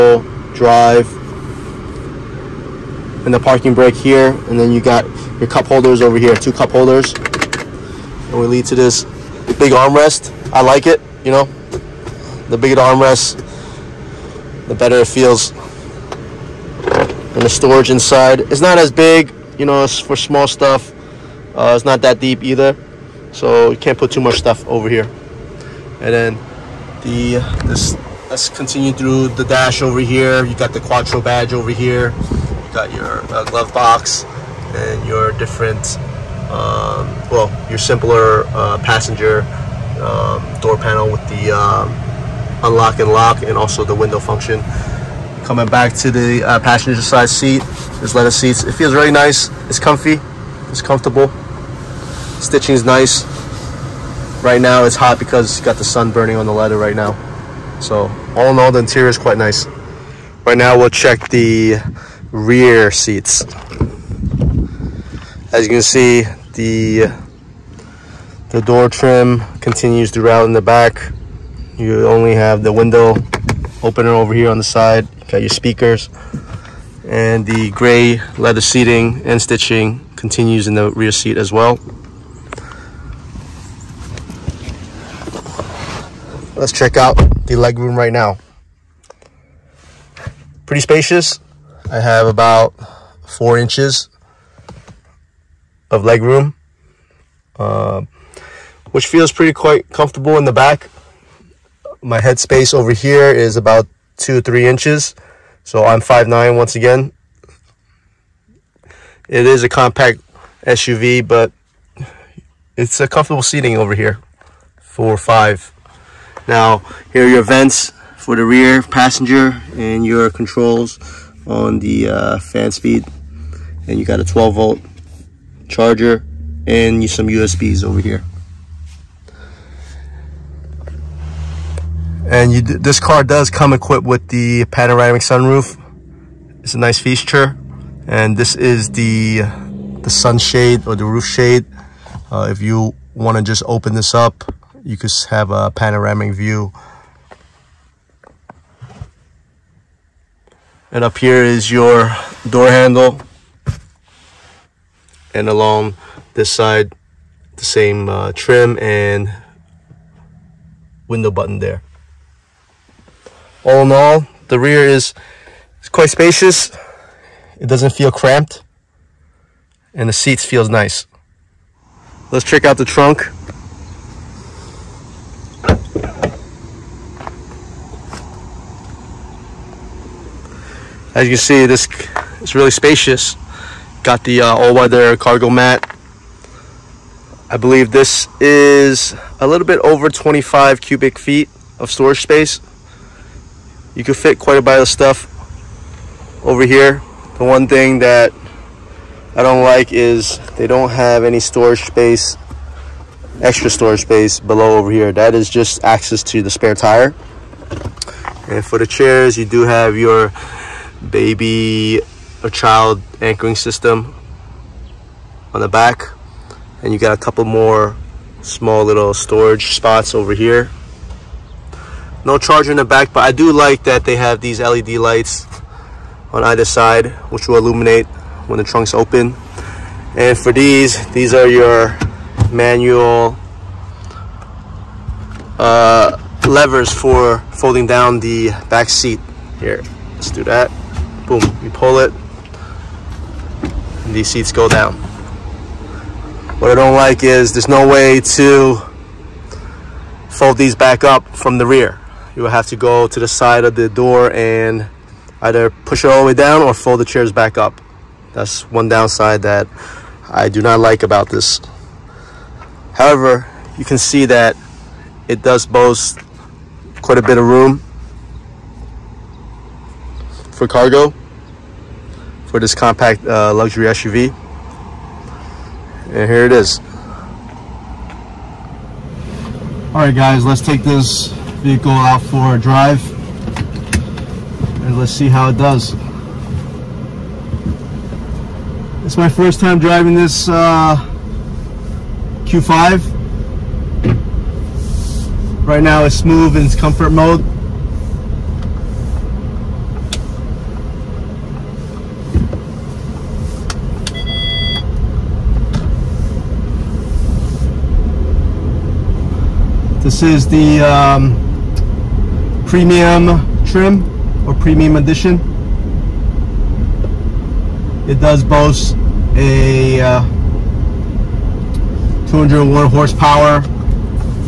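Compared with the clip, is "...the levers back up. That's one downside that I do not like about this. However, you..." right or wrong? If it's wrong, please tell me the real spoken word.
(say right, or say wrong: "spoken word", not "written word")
wrong: "chairs", not "levers".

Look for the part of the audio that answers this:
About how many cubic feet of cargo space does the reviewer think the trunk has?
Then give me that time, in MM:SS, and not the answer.
03:10.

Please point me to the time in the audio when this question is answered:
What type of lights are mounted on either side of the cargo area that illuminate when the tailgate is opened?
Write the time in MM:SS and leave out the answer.
03:44.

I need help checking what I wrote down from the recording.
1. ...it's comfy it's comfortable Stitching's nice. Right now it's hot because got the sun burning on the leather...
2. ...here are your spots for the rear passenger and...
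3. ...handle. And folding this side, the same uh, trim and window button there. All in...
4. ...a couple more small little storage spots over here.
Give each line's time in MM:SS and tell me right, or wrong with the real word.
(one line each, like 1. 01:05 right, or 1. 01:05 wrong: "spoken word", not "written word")
1. 00:49 right
2. 01:57 wrong: "vents", not "spots"
3. 02:32 wrong: "along", not "folding"
4. 03:37 right.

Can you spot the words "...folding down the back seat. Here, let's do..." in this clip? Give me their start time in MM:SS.
03:57.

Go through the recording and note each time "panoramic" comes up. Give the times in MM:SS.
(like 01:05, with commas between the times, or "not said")
02:14, 02:25.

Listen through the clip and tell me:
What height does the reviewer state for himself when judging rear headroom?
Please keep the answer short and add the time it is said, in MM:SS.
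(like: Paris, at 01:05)
5'9, at 01:46.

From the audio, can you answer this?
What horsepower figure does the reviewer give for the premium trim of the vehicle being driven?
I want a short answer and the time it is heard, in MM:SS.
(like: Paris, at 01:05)
201 horsepower, at 05:22.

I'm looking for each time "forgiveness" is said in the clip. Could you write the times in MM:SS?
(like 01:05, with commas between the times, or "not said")
not said.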